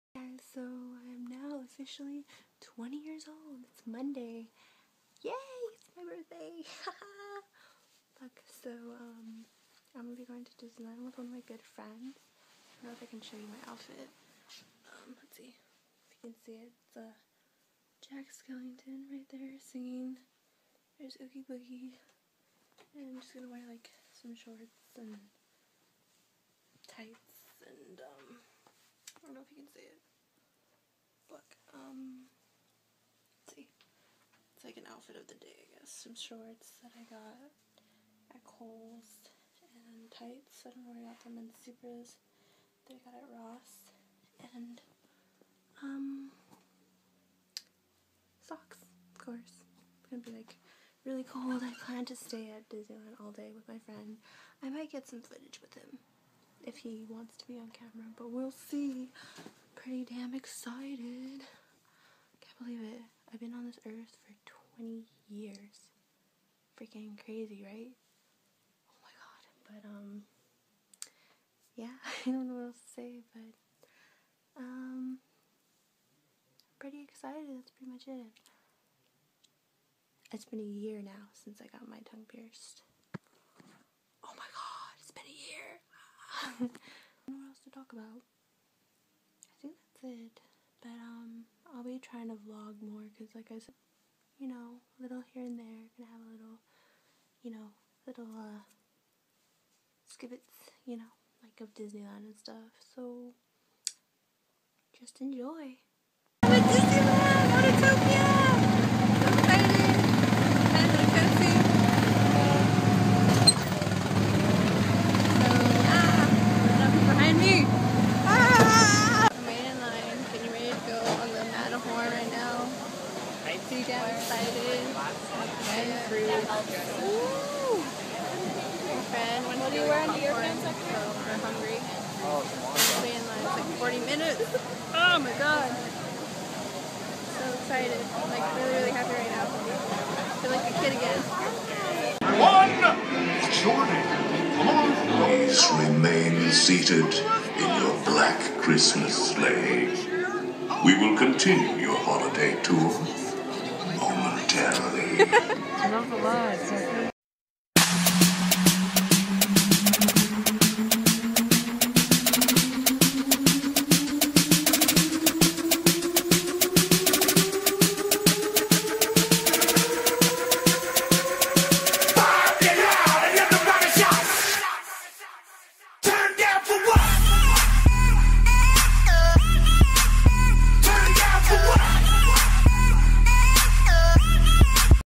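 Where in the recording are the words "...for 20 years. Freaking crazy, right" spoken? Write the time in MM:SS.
01:04.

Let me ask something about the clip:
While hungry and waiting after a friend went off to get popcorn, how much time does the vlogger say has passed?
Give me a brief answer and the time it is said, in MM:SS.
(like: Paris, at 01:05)
40 minutes, at 02:13.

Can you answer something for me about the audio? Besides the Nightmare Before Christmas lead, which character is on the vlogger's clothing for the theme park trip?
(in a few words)
Oogie Boogie.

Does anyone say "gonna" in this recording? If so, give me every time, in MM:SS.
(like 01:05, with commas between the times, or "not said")
00:10, 00:23, 00:50, 01:35.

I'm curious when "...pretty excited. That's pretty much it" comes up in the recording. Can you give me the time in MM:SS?
01:16.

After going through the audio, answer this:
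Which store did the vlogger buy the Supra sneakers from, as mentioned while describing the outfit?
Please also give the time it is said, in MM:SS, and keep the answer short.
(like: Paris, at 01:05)
Ross, at 00:43.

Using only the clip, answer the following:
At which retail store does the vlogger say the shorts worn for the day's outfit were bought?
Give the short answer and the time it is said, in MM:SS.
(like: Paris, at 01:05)
Kohl's, at 00:38.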